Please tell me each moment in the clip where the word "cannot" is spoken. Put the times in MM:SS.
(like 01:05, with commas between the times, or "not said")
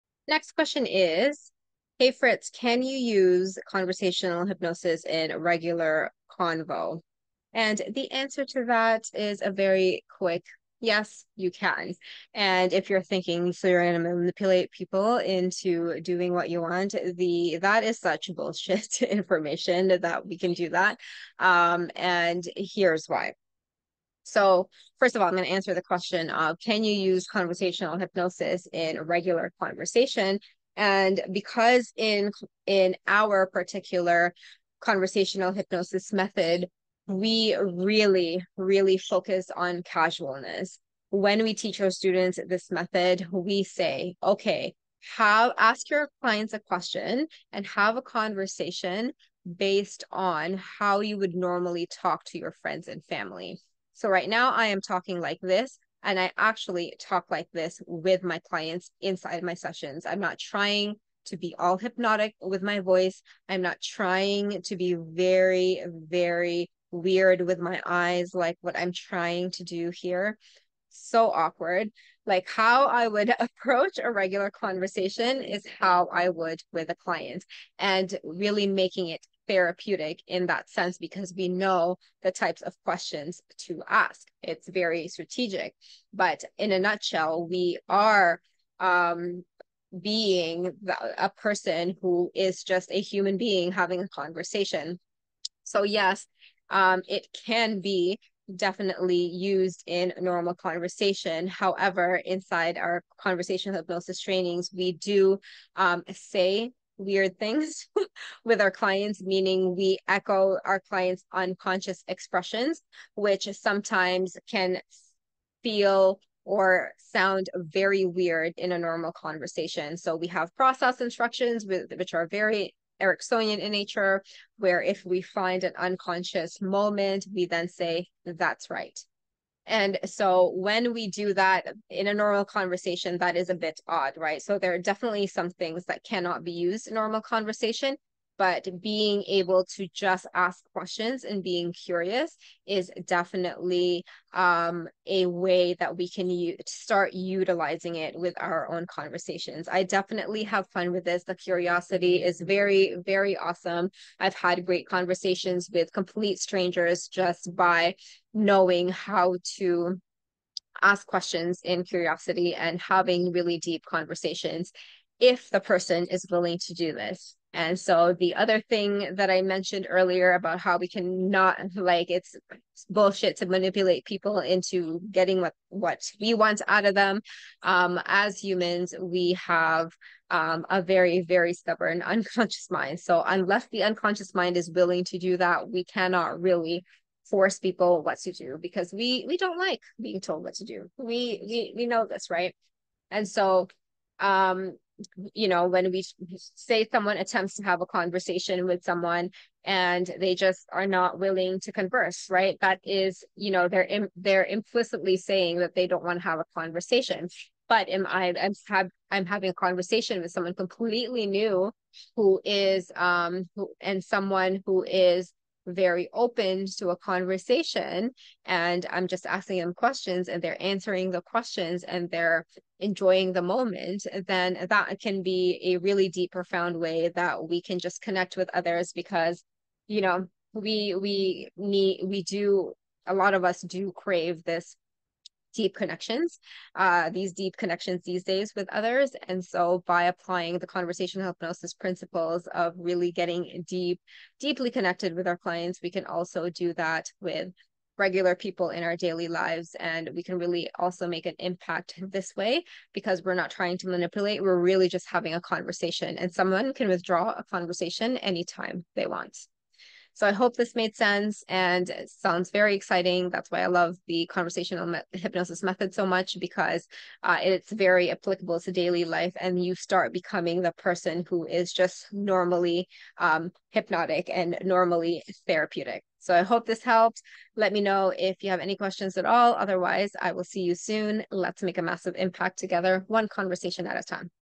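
02:16, 03:05.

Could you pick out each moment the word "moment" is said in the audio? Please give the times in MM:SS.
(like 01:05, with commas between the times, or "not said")
02:06, 03:43.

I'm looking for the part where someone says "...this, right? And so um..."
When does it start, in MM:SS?
03:12.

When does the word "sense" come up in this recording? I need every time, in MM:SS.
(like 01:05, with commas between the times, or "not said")
01:20, 04:20.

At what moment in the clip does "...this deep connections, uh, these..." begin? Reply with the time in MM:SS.
03:54.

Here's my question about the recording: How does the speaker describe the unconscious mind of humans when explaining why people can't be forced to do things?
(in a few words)
very stubborn.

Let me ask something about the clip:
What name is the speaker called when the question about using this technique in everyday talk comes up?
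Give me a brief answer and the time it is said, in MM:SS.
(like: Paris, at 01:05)
Fritz, at 00:02.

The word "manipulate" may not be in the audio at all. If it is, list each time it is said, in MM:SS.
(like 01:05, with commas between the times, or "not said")
00:14, 02:53, 04:13.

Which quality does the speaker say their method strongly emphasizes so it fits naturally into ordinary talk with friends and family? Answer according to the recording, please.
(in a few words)
casualness.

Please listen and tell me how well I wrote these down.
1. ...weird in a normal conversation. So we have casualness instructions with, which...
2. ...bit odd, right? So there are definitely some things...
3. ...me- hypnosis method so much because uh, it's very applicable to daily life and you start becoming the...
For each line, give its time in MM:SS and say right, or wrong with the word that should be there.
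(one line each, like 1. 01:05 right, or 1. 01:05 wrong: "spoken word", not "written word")
1. 01:58 wrong: "process", not "casualness"
2. 02:13 right
3. 04:24 right.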